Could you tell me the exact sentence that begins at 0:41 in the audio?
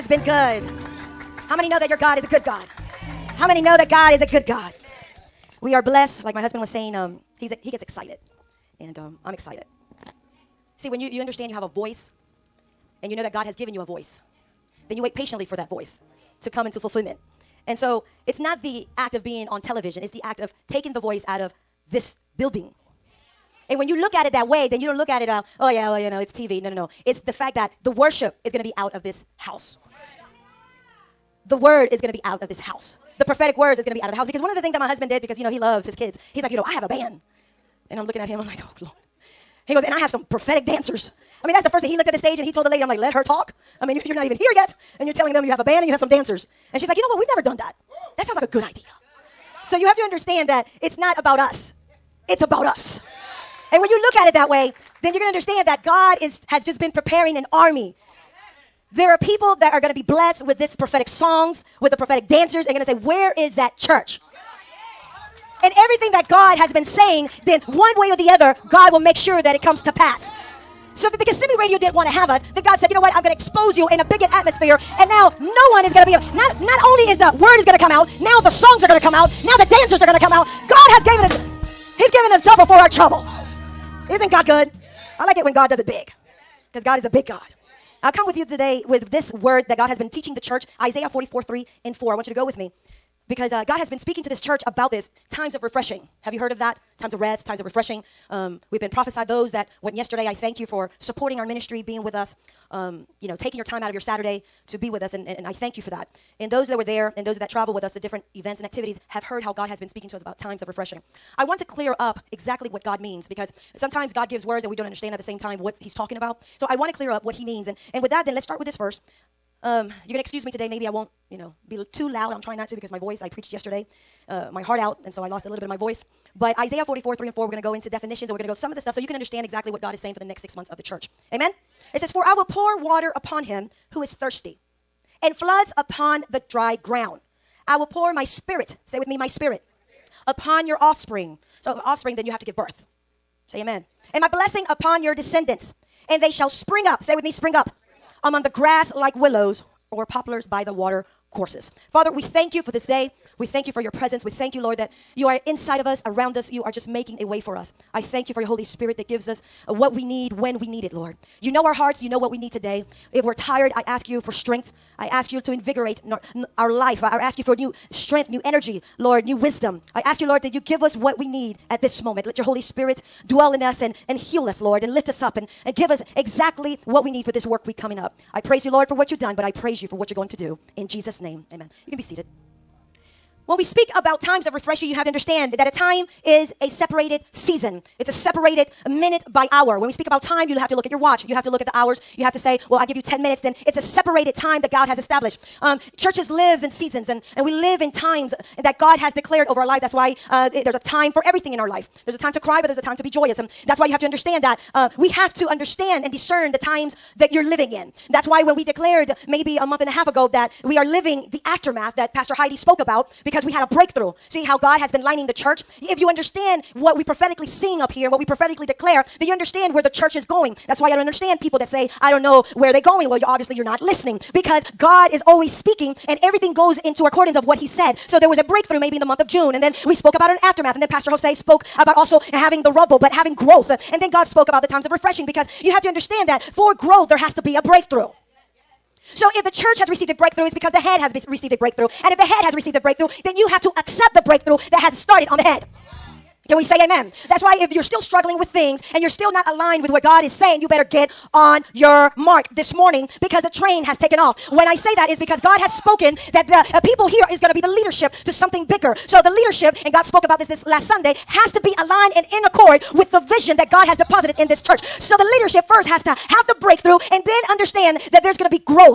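He looked at the stage and he told the lady, I'm like, let her talk.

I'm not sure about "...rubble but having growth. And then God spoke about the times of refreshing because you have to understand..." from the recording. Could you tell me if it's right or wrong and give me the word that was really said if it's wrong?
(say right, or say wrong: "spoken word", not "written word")
right.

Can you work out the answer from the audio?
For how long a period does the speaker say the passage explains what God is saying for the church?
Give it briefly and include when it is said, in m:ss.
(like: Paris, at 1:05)
6 months, at 2:10.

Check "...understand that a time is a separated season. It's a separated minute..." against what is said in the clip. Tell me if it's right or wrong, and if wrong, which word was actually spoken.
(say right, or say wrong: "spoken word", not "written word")
right.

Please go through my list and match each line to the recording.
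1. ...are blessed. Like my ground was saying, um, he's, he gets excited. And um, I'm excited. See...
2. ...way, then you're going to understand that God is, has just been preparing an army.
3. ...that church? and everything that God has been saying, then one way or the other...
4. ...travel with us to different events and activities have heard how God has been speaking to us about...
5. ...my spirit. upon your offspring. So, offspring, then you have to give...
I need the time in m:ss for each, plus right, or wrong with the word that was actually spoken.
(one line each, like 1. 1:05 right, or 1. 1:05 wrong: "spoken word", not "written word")
1. 0:05 wrong: "husband", not "ground"
2. 0:54 right
3. 1:03 right
4. 1:47 right
5. 2:19 right.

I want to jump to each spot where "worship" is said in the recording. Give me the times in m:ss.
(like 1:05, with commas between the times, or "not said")
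0:27.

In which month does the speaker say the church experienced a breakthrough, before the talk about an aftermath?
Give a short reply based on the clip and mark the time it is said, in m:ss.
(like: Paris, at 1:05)
June, at 3:49.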